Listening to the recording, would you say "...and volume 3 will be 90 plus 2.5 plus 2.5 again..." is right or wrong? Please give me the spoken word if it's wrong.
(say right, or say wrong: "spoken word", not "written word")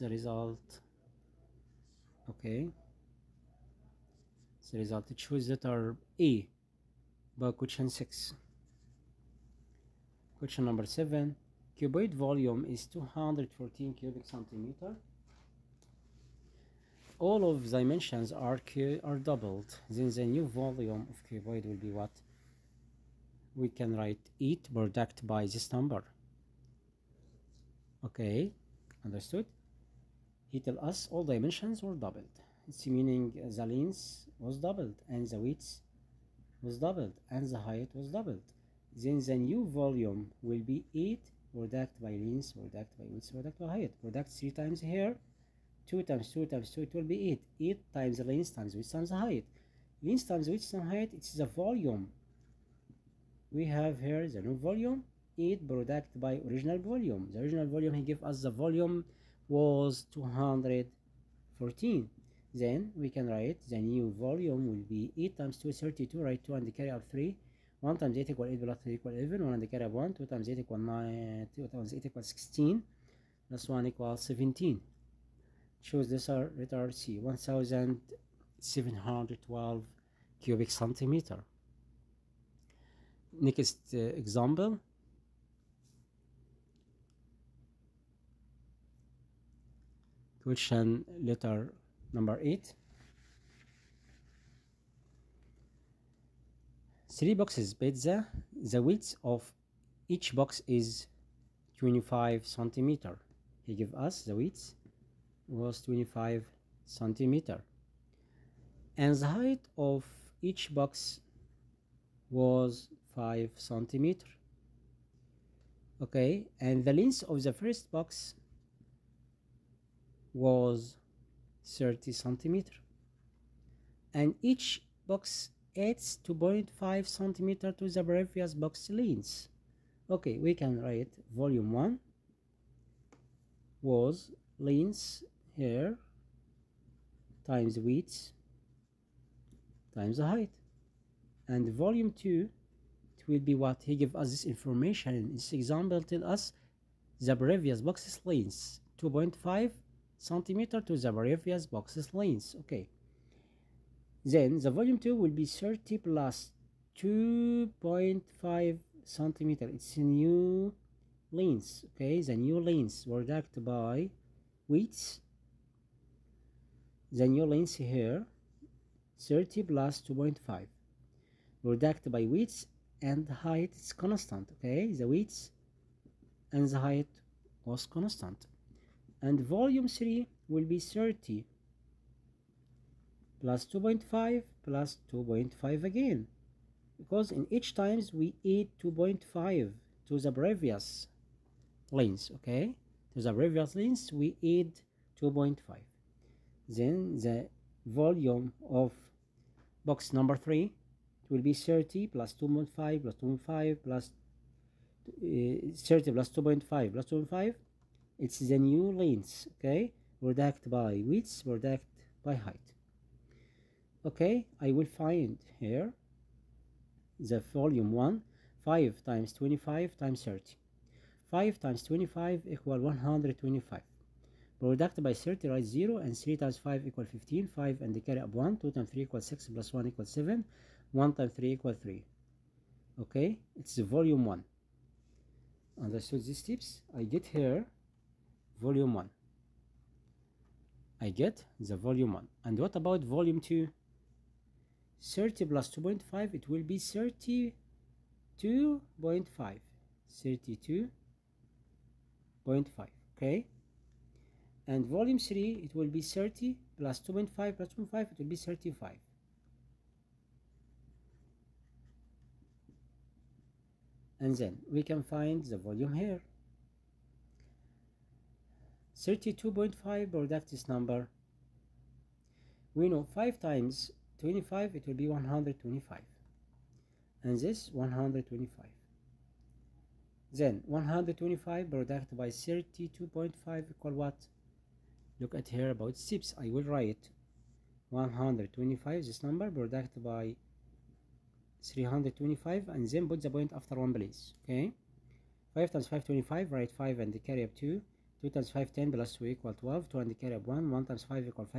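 wrong: "30", not "90".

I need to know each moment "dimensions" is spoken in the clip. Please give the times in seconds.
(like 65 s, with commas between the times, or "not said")
17 s, 31 s.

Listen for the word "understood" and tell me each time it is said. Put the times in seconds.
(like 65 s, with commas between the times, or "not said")
29 s, 235 s.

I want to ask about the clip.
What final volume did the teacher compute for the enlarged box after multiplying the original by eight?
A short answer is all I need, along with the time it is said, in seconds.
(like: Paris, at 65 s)
1712 cubic centimeters, at 77 s.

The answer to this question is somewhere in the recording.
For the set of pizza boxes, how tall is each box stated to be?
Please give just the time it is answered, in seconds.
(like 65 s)
113 s.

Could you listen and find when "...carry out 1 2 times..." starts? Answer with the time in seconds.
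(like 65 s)
69 s.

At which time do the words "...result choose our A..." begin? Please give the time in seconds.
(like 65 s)
4 s.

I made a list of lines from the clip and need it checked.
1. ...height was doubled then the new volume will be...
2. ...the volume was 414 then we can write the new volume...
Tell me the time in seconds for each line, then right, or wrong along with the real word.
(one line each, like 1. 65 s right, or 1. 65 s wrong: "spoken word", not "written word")
1. 37 s right
2. 58 s wrong: "214", not "414".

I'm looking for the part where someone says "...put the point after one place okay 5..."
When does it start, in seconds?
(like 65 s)
293 s.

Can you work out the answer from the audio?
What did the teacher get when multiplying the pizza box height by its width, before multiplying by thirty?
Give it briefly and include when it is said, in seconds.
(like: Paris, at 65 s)
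125, at 221 s.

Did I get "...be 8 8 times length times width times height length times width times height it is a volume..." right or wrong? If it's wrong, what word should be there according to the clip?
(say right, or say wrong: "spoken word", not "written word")
right.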